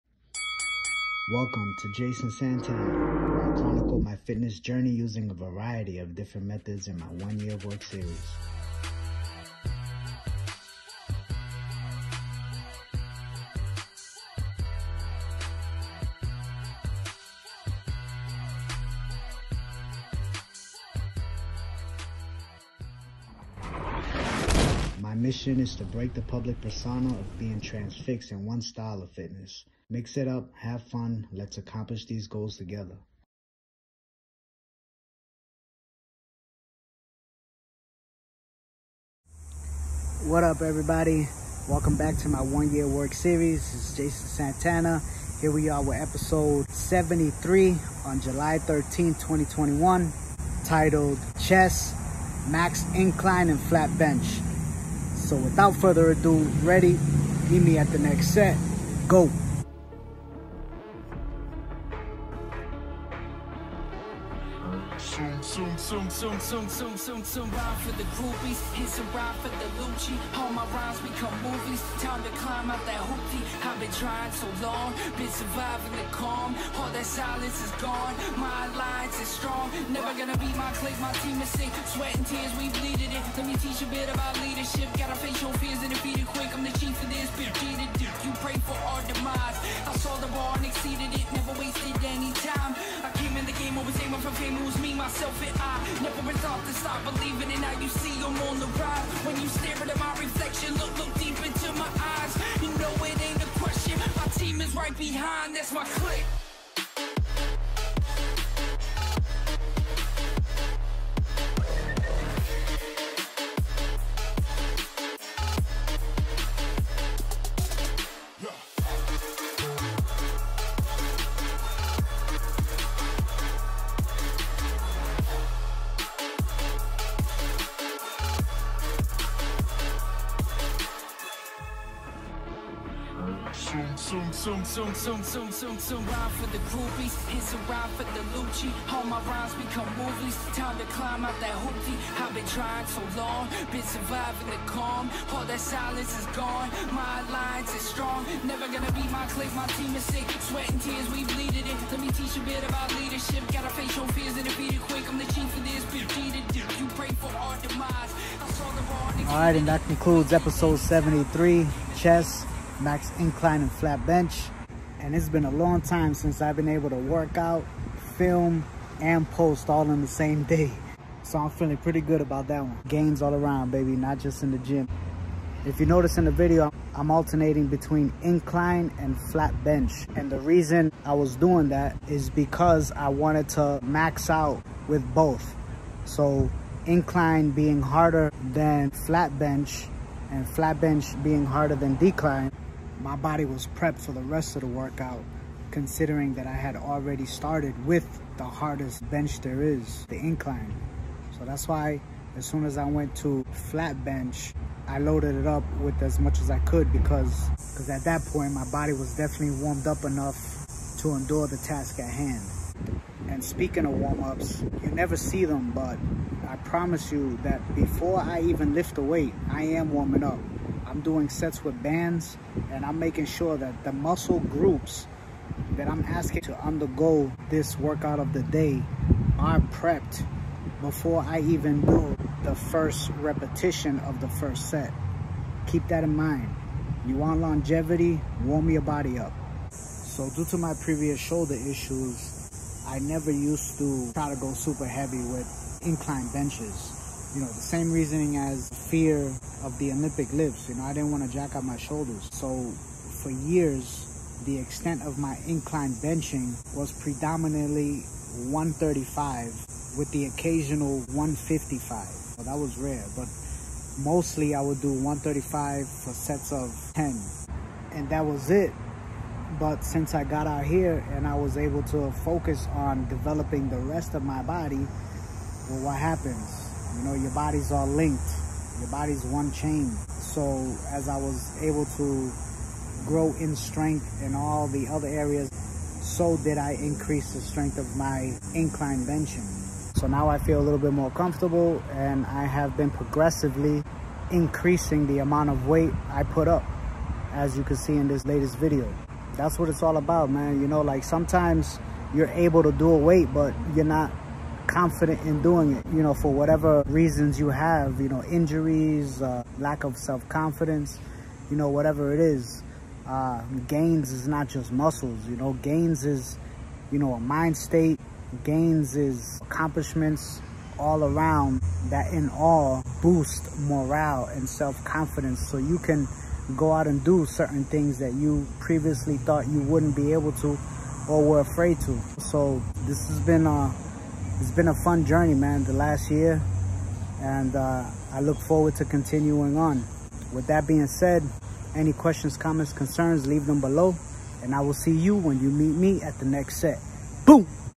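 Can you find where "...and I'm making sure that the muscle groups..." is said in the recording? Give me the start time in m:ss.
3:42.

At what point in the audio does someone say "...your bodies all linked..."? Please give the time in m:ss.
4:37.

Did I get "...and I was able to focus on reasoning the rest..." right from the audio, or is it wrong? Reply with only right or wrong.
wrong.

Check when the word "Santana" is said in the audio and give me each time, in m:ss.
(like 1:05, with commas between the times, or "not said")
0:02, 0:44.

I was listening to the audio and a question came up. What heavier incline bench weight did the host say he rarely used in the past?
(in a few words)
155.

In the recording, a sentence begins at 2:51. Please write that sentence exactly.
So I'm feeling pretty good about that one.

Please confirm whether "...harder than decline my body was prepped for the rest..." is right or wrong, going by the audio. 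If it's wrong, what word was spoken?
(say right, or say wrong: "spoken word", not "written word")
right.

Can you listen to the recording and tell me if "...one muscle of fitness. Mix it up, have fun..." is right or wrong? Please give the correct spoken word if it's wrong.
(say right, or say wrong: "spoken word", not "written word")
wrong: "style", not "muscle".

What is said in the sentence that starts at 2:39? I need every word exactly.
All right, and that concludes episode 73, Chest max incline and flat bench.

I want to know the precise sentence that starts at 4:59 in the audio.
That's what it's all about, man.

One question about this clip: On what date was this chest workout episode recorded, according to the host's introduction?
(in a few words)
July 13, 2021.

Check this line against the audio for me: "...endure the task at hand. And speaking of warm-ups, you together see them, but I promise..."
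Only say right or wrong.
wrong.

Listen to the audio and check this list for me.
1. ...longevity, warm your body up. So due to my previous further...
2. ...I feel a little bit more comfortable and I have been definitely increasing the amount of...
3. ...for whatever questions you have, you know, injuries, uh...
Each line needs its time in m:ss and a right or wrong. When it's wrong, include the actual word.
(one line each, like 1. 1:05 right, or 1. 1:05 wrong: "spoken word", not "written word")
1. 3:57 wrong: "shoulder", not "further"
2. 4:50 wrong: "progressively", not "definitely"
3. 5:06 wrong: "reasons", not "questions".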